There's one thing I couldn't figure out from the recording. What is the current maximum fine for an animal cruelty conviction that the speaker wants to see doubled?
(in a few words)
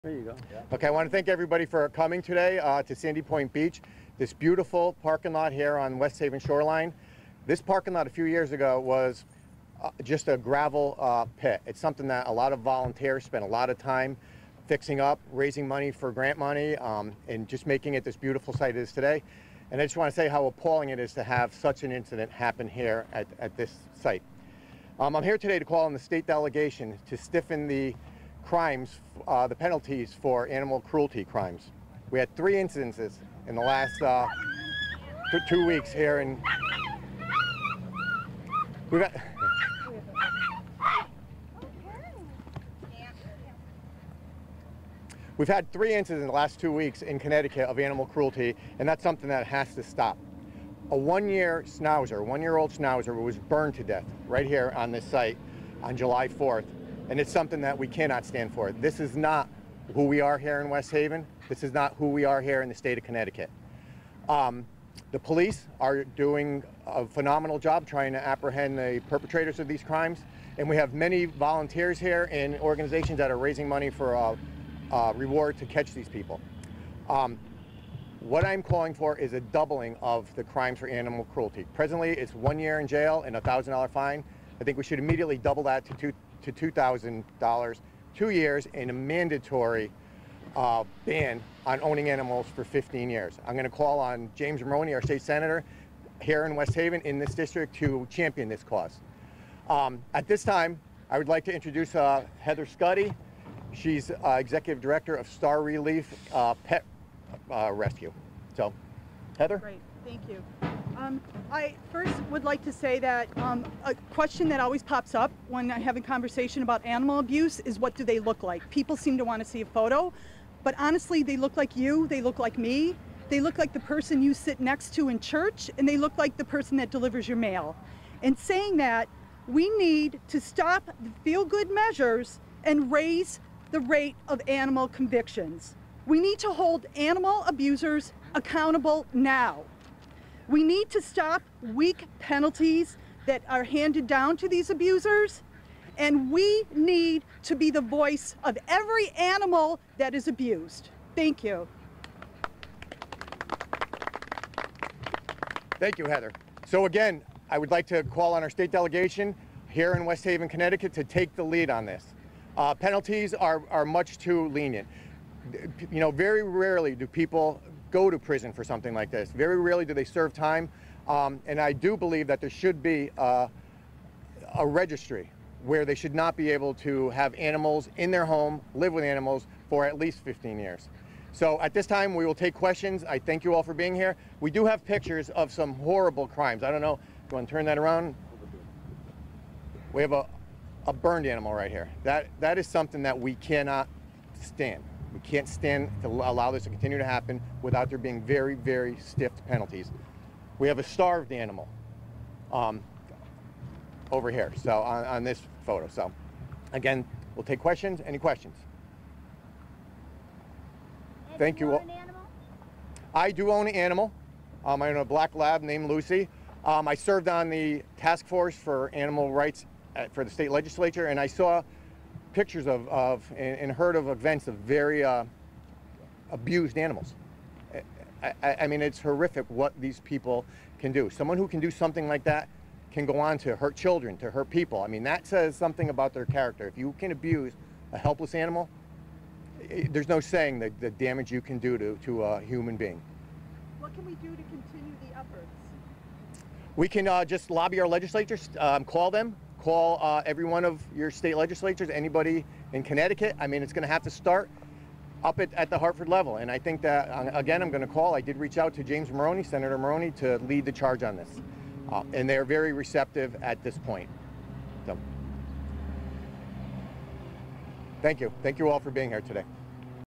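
$1,000.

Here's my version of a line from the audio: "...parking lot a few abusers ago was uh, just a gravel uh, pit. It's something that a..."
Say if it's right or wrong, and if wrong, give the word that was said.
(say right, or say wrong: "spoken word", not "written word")
wrong: "years", not "abusers".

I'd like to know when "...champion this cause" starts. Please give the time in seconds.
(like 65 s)
98 s.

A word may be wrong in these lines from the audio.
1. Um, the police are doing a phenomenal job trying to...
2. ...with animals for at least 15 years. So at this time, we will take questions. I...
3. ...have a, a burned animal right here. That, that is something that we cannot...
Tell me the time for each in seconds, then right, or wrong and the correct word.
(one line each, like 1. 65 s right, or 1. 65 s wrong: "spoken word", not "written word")
1. 64 s right
2. 178 s right
3. 190 s right.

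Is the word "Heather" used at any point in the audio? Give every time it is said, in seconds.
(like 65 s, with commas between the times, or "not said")
102 s, 109 s, 156 s.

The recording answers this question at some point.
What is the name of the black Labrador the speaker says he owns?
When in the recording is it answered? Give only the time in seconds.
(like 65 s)
215 s.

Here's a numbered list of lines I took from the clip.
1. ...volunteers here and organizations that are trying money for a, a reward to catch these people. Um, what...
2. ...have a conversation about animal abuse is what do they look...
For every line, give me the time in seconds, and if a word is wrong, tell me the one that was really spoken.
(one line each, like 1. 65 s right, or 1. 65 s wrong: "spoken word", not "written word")
1. 71 s wrong: "raising", not "trying"
2. 115 s right.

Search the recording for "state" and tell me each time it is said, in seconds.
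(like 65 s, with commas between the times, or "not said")
25 s, 62 s, 95 s, 158 s, 220 s, 251 s.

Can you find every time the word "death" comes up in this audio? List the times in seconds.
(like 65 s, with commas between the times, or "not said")
53 s.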